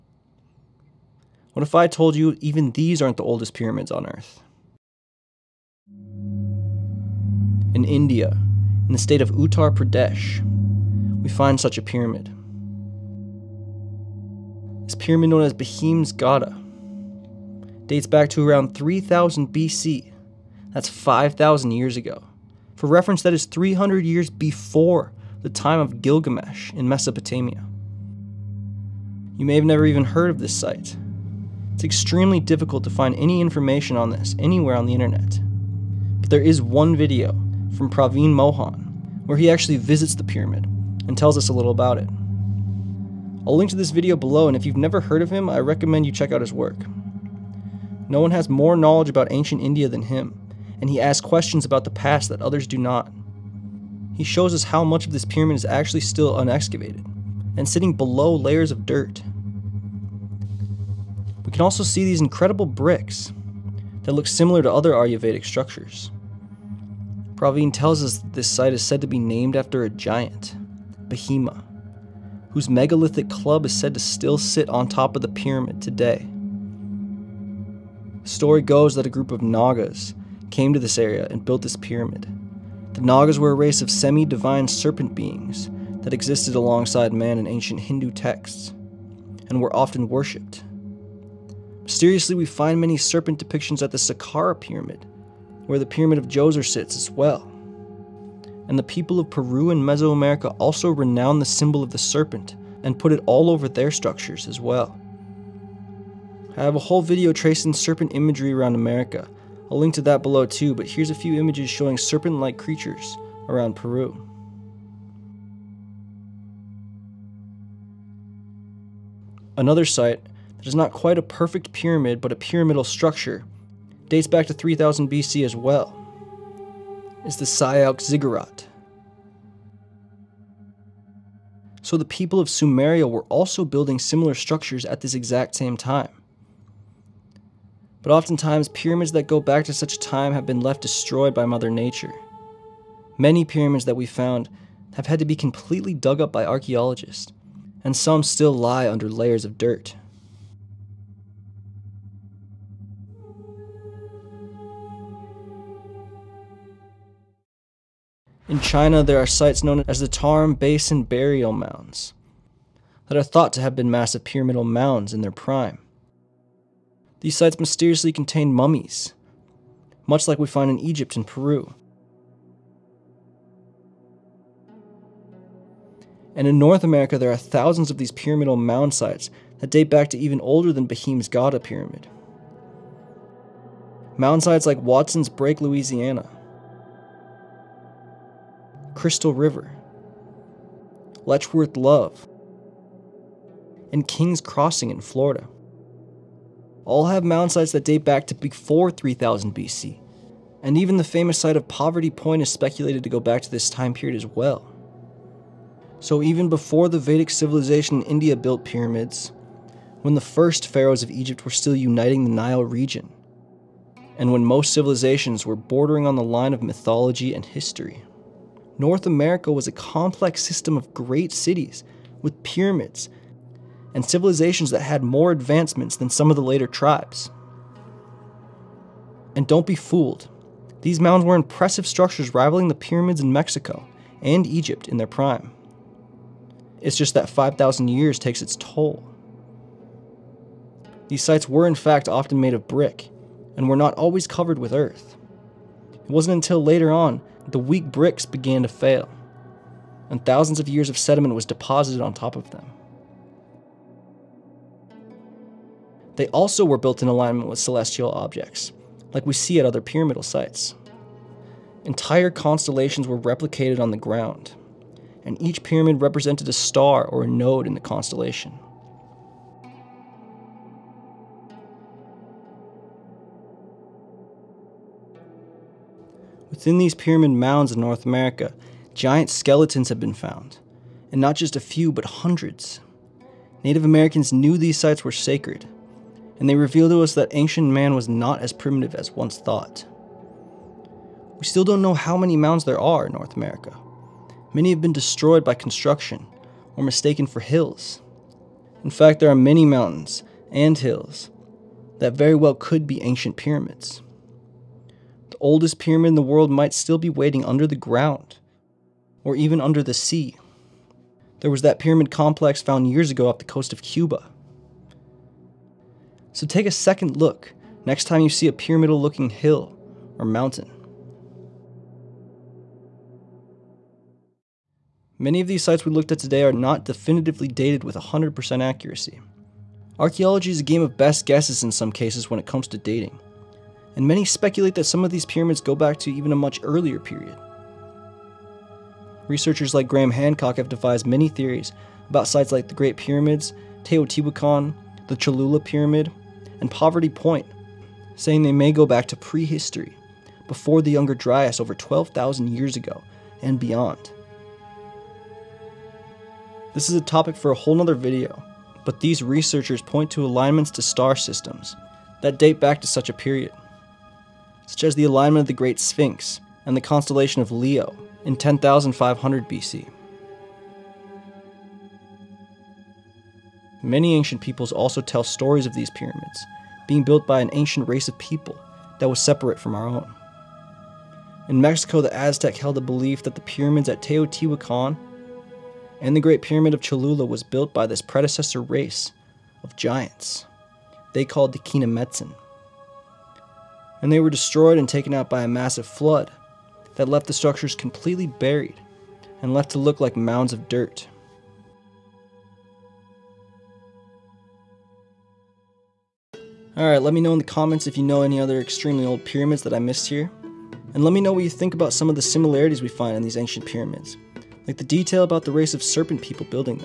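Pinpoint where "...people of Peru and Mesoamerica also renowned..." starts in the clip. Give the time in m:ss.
1:38.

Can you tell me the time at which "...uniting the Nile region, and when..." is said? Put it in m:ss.
3:31.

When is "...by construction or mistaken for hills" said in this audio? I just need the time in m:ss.
4:55.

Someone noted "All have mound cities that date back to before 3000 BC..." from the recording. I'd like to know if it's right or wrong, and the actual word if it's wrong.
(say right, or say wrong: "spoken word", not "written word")
wrong: "sites", not "cities".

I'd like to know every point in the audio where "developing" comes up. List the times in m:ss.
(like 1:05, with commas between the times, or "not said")
not said.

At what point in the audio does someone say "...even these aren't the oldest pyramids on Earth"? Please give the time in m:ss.
0:02.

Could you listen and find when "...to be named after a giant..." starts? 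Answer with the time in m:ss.
1:09.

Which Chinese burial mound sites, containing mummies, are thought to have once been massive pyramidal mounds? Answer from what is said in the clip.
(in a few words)
Tarim Basin Burial Mounds.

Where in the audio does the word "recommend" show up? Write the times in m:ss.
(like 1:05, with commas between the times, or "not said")
0:45.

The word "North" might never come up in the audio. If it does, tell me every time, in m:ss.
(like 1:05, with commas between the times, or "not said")
2:56, 3:38, 4:37, 4:53.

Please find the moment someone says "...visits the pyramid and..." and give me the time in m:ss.
0:39.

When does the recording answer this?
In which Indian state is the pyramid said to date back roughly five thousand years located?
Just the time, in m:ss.
0:09.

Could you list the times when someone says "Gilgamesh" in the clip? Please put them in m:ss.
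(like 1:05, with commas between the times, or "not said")
0:26.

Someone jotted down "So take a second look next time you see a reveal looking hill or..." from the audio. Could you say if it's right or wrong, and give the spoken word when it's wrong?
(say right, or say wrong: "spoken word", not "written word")
wrong: "pyramidal", not "reveal".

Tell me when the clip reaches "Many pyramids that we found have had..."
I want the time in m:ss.
2:23.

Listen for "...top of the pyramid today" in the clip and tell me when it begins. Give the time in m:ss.
1:14.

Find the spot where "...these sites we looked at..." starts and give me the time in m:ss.
5:25.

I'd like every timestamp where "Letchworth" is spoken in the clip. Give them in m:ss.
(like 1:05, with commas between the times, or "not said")
3:11.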